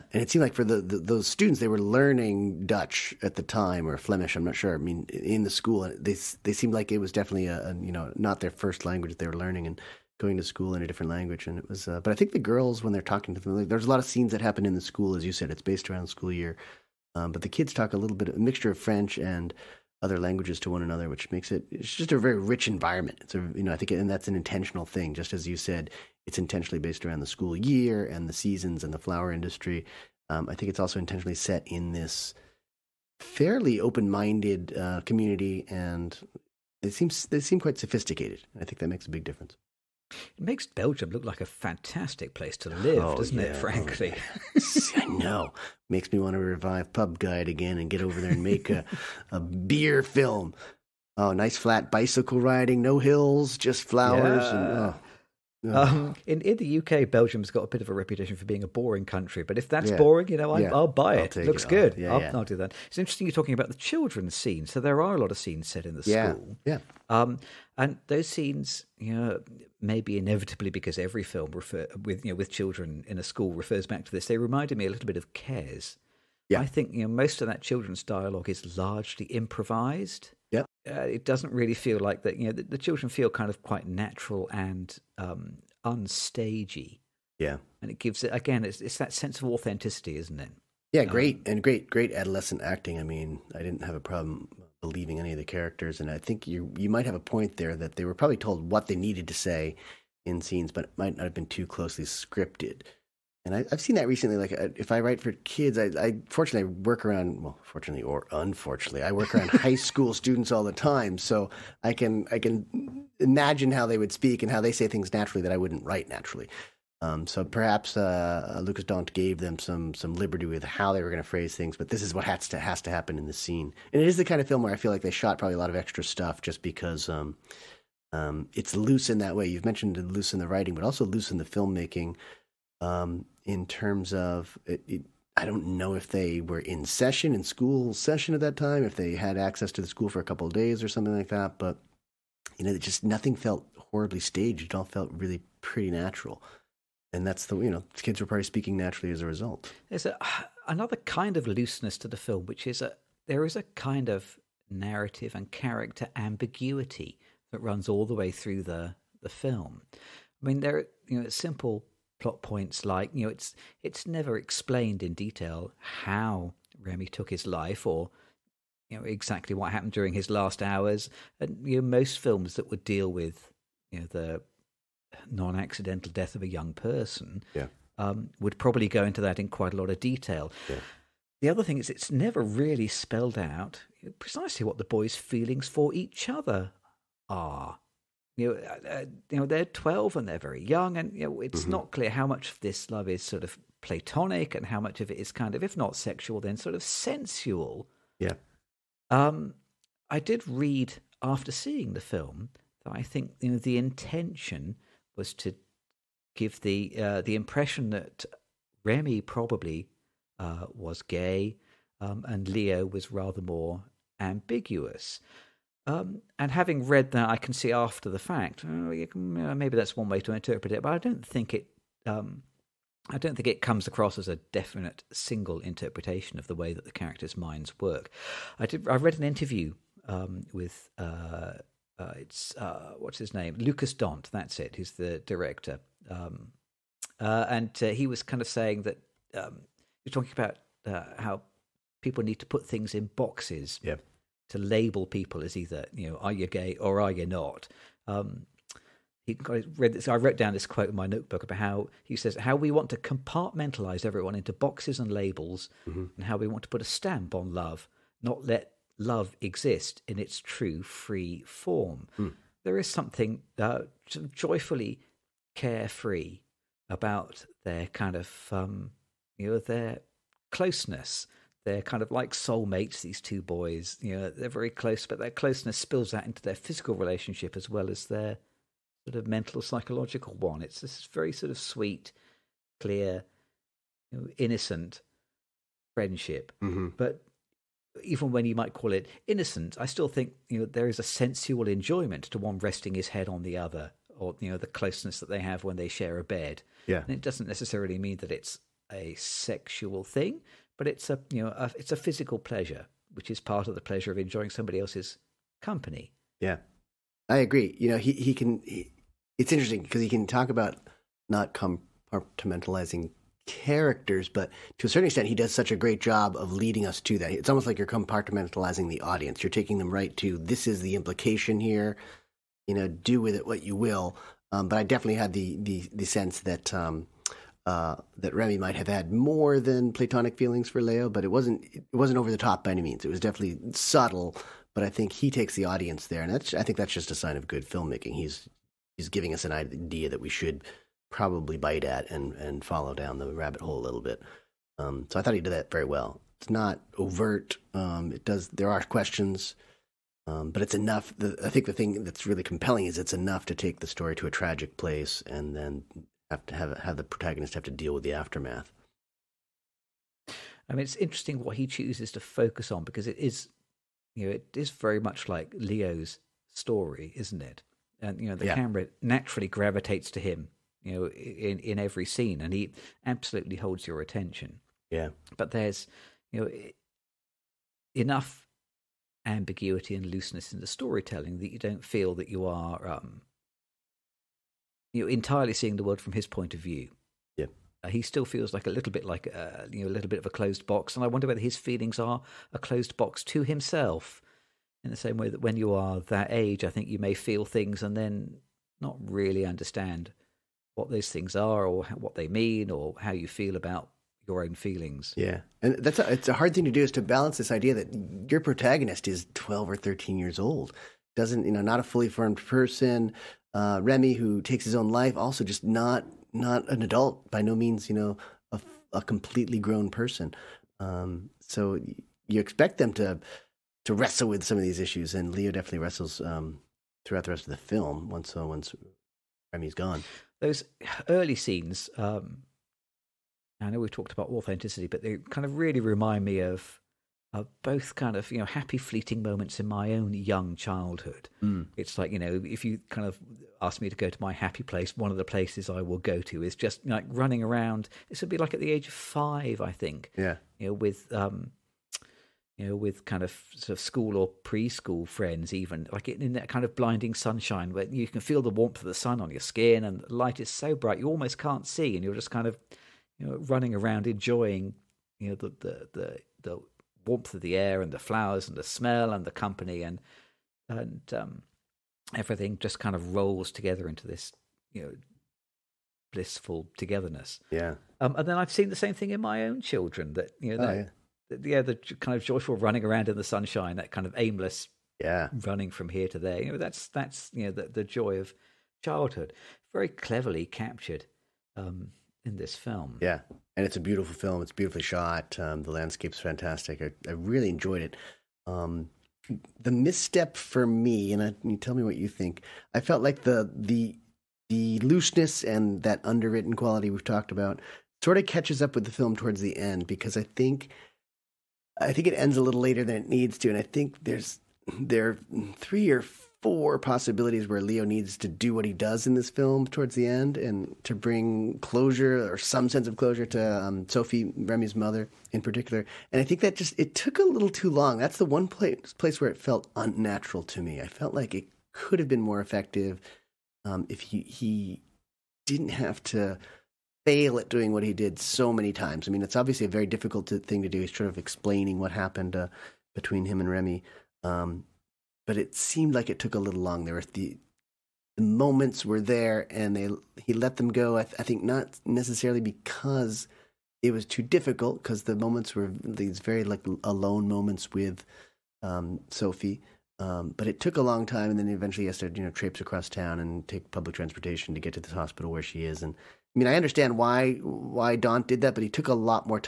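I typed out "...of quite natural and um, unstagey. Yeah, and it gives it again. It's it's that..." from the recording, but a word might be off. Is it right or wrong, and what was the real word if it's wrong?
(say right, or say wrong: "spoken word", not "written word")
right.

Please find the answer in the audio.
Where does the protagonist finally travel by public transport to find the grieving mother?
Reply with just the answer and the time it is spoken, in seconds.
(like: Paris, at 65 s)
Hospital, at 564 s.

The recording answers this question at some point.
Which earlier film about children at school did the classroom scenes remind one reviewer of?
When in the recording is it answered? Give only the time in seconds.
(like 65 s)
75 s.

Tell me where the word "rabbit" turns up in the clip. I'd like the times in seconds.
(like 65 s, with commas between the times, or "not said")
343 s.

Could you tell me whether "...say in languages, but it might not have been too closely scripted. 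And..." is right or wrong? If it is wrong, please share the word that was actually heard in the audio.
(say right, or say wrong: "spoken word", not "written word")
wrong: "scenes", not "languages".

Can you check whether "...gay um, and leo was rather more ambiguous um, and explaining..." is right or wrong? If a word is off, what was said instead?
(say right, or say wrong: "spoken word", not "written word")
wrong: "having", not "explaining".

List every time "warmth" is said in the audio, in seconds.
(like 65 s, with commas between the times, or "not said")
458 s, 467 s.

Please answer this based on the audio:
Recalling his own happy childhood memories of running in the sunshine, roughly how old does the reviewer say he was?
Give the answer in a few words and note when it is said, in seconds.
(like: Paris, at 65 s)
5, at 448 s.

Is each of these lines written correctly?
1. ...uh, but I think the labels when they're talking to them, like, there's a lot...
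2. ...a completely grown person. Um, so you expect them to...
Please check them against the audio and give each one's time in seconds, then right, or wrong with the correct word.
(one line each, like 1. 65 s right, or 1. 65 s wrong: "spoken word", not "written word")
1. 11 s wrong: "girls", not "labels"
2. 418 s right.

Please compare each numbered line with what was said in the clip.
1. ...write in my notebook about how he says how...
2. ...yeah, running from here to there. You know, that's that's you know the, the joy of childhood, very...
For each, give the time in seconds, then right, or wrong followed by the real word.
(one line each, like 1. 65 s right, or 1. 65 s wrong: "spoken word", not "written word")
1. 250 s wrong: "quote", not "write"
2. 484 s right.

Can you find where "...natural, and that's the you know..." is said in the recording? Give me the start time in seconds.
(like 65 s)
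145 s.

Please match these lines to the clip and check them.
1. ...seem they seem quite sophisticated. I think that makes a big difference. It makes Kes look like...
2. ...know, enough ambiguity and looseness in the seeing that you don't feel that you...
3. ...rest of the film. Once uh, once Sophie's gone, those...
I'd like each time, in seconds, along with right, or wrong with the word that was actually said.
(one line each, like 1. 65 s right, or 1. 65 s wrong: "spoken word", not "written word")
1. 36 s wrong: "Belgium", not "Kes"
2. 376 s wrong: "storytelling", not "seeing"
3. 427 s wrong: "Remy", not "Sophie".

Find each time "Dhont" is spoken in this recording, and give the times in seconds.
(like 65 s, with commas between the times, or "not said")
118 s, 233 s, 567 s.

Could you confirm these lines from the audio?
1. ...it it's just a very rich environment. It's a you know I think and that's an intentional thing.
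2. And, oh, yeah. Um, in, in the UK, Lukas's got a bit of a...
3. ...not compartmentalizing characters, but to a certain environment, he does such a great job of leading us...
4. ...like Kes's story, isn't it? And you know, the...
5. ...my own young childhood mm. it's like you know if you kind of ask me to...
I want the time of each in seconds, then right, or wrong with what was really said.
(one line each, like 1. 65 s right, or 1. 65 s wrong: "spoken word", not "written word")
1. 21 s right
2. 54 s wrong: "Belgium", not "Lukas"
3. 311 s wrong: "extent", not "environment"
4. 365 s wrong: "Leo", not "Kes"
5. 439 s right.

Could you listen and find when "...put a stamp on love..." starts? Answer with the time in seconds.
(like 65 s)
256 s.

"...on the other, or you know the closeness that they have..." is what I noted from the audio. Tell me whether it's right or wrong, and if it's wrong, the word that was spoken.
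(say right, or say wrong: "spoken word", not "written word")
right.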